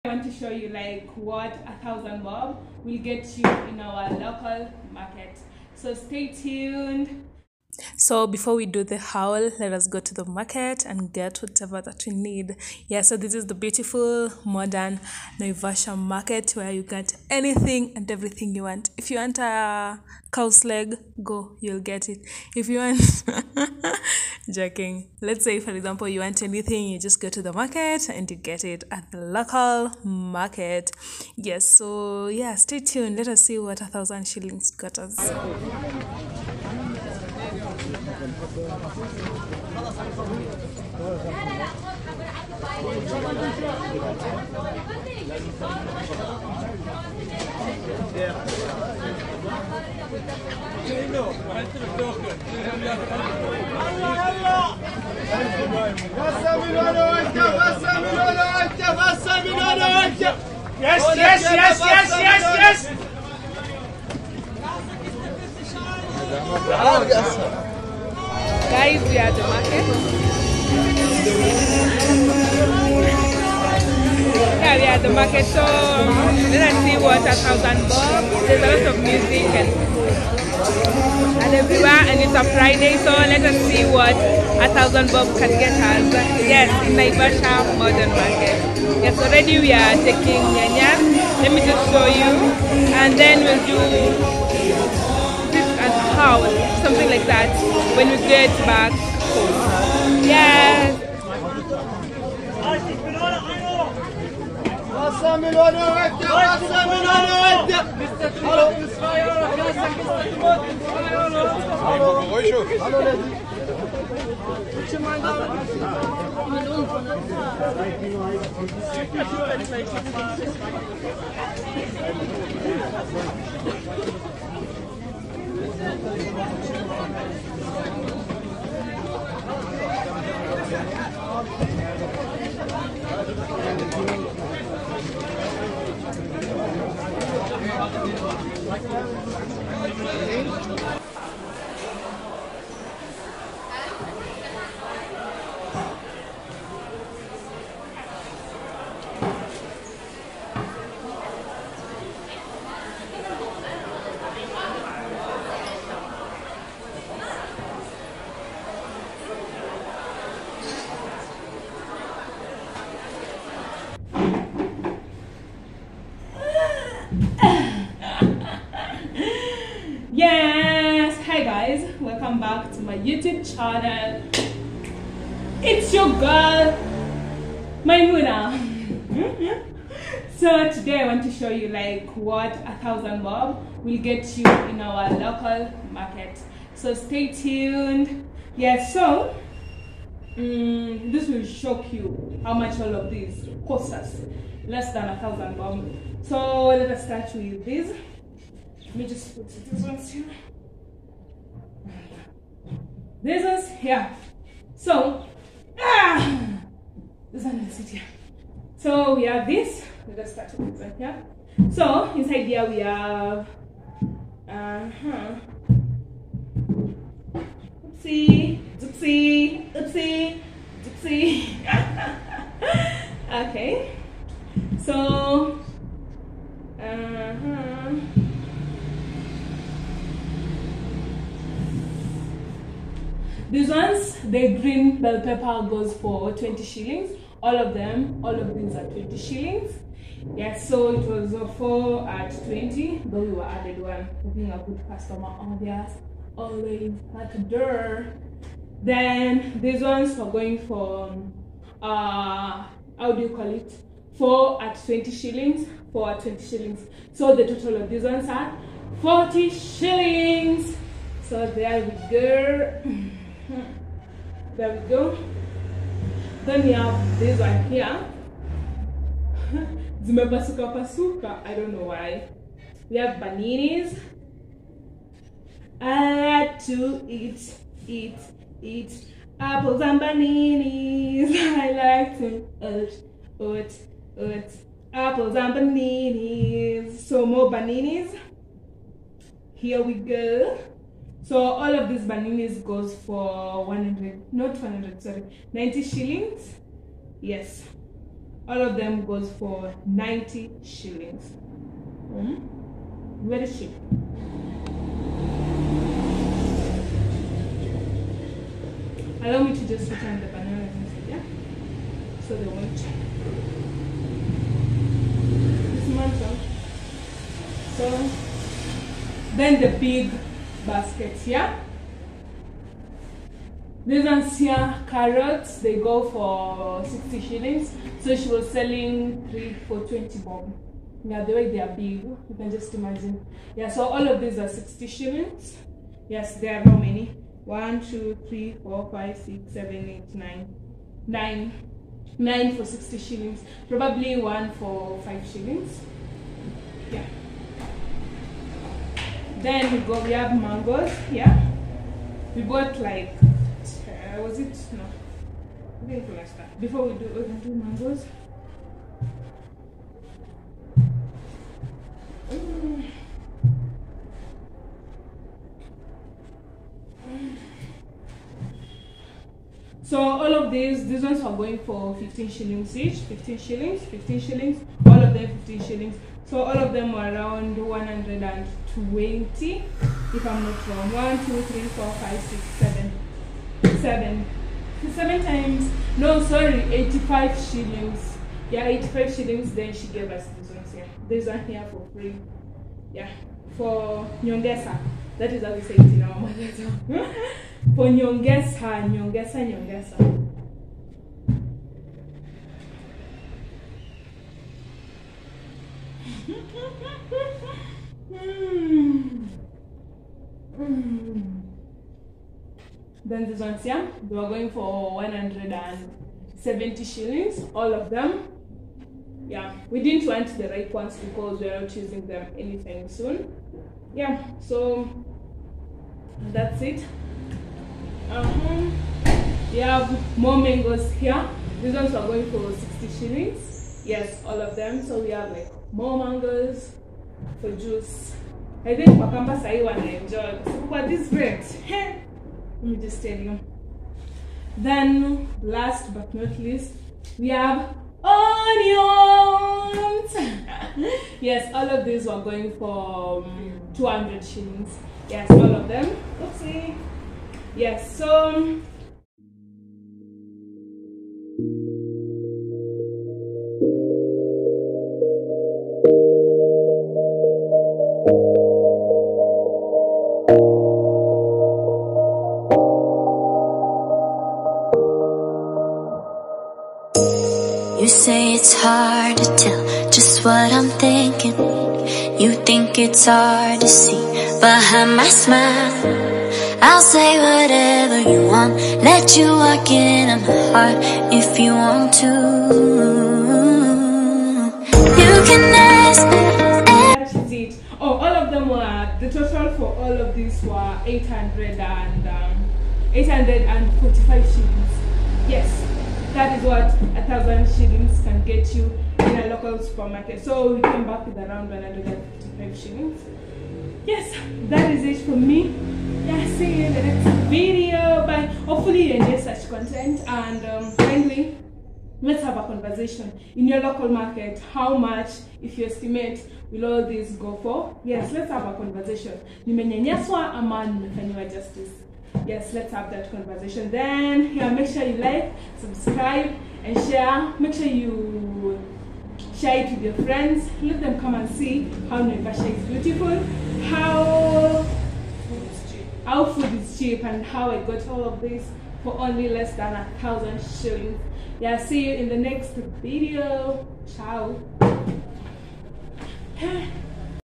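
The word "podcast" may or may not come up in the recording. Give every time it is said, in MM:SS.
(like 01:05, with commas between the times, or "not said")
not said.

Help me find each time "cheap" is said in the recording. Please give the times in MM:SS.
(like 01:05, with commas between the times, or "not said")
05:03, 09:06.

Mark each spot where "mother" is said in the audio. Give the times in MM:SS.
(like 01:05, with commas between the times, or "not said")
06:36.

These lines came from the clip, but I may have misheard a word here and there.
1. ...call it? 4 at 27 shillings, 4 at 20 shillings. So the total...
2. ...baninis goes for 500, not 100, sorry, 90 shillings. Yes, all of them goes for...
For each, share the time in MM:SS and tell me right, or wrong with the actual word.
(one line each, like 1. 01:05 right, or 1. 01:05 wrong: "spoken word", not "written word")
1. 04:13 wrong: "20", not "27"
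2. 04:52 wrong: "100", not "500".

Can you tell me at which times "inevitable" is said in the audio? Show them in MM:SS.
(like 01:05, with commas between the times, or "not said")
not said.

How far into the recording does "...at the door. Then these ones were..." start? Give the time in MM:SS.
04:07.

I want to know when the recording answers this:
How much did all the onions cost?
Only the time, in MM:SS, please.
07:33.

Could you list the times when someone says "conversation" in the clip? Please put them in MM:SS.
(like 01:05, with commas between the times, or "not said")
08:42, 08:48, 08:53.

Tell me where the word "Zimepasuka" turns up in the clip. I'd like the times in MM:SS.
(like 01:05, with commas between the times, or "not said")
04:30.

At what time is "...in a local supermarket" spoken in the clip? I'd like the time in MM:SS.
08:28.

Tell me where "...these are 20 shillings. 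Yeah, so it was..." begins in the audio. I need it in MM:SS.
03:58.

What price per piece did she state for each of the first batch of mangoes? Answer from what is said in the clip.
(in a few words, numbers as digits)
15 shillings.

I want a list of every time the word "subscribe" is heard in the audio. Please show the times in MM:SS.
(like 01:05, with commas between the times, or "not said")
08:55.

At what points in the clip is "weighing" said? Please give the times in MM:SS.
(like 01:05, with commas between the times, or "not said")
not said.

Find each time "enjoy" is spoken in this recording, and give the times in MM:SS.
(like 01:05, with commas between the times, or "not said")
07:19, 08:39.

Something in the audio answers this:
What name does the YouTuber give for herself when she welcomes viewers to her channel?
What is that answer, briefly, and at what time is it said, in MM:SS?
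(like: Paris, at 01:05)
Maimuna, at 02:57.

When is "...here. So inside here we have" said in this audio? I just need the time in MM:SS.
03:30.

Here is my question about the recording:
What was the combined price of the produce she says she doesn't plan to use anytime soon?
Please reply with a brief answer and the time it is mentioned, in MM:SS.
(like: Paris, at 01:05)
170 shillings, at 06:54.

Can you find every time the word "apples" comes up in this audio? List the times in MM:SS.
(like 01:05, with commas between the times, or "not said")
04:39, 04:44.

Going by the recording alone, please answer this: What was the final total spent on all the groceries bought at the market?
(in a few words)
845 shillings.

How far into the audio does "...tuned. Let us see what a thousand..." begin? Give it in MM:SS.
00:32.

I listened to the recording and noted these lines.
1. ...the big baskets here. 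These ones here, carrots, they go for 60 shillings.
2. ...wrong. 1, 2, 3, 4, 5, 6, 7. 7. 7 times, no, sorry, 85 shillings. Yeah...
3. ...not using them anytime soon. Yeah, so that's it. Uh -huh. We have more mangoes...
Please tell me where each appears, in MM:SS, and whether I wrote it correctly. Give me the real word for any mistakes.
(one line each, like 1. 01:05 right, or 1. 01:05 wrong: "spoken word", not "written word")
1. 05:19 right
2. 06:20 right
3. 07:01 right.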